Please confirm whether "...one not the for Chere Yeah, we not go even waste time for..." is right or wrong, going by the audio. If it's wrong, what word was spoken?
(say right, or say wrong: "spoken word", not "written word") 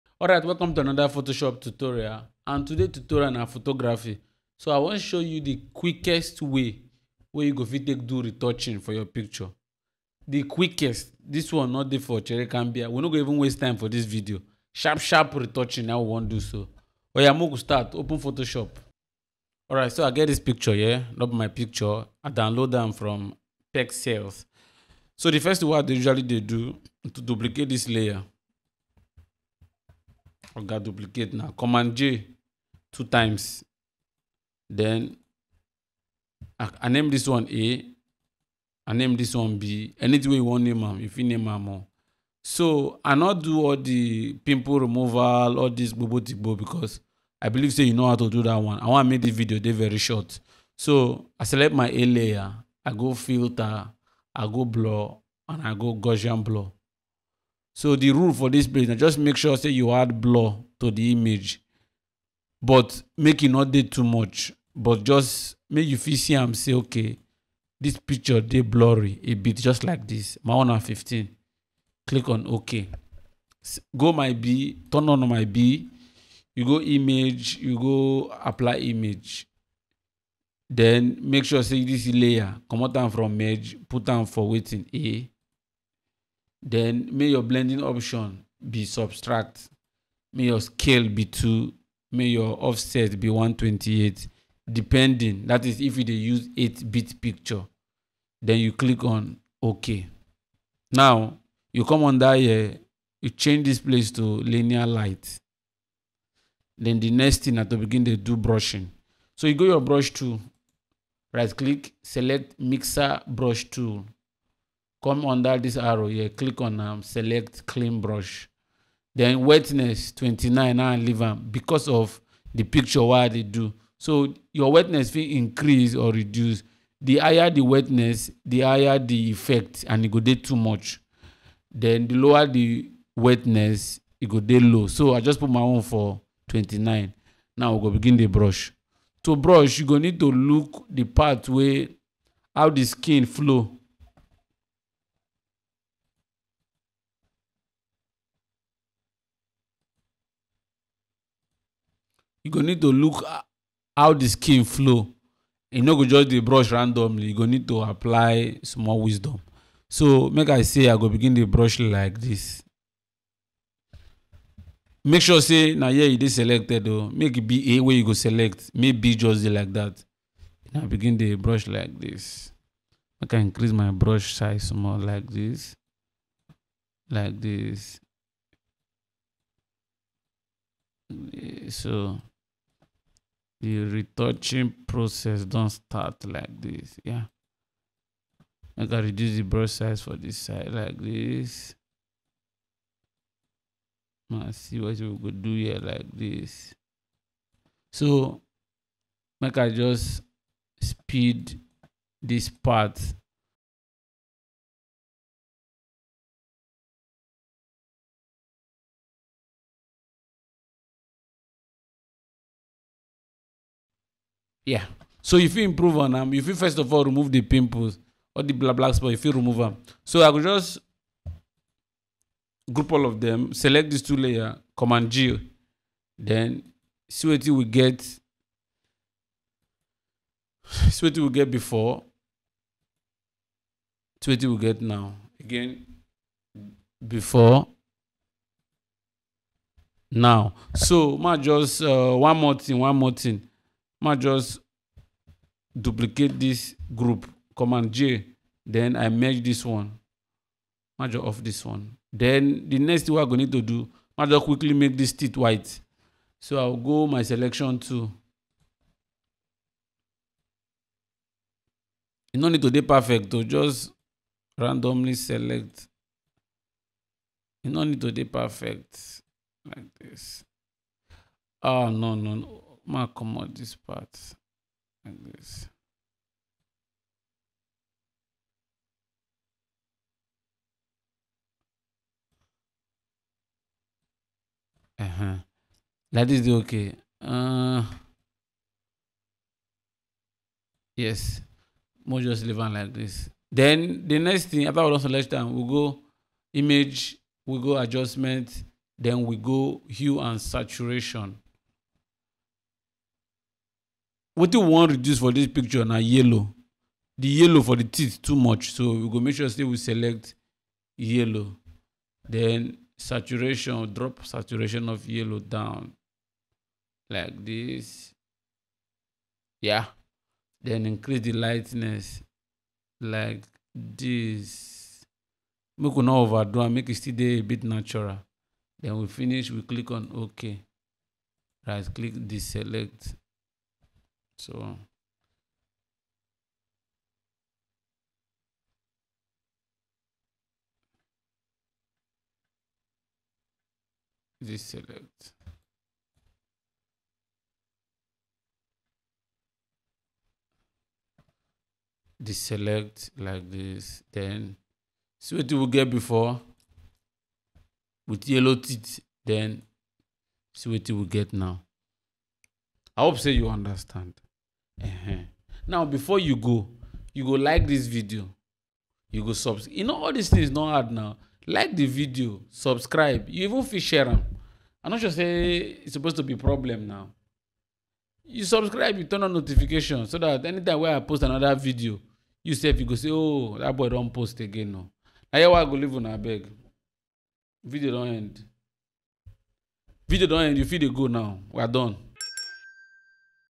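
wrong: "Cambia", not "Yeah".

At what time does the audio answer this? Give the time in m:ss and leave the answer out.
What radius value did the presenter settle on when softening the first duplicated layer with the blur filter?
1:10.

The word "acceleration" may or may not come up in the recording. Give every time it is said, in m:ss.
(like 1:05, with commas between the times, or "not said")
not said.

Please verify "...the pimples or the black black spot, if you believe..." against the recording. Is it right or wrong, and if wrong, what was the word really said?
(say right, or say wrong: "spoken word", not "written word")
wrong: "remove", not "believe".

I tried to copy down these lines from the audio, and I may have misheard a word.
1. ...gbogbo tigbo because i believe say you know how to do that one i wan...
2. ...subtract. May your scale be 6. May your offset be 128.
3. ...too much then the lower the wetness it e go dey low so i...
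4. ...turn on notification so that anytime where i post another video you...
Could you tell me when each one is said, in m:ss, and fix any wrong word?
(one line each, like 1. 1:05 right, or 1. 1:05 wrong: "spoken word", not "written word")
1. 0:45 right
2. 1:28 wrong: "2", not "6"
3. 2:10 right
4. 6:19 right.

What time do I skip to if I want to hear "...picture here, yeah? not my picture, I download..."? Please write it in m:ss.
0:20.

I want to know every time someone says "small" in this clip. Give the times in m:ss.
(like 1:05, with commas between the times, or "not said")
2:38, 2:54.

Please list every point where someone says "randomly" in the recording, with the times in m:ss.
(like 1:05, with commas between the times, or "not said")
2:36, 4:24.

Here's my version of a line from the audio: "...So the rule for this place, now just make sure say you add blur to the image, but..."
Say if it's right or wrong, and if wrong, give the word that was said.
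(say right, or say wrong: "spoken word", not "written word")
right.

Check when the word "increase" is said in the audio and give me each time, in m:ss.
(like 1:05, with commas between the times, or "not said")
2:05, 2:53, 5:20.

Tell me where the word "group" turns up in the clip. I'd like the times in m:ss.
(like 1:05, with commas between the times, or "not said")
3:42, 4:06.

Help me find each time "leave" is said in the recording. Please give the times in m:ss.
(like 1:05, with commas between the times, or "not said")
2:00, 4:52, 6:25.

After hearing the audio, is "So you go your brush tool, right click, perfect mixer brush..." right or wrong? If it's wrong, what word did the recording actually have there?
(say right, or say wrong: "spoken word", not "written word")
wrong: "select", not "perfect".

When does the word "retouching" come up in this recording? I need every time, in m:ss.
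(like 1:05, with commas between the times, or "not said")
0:08, 0:15, 3:03.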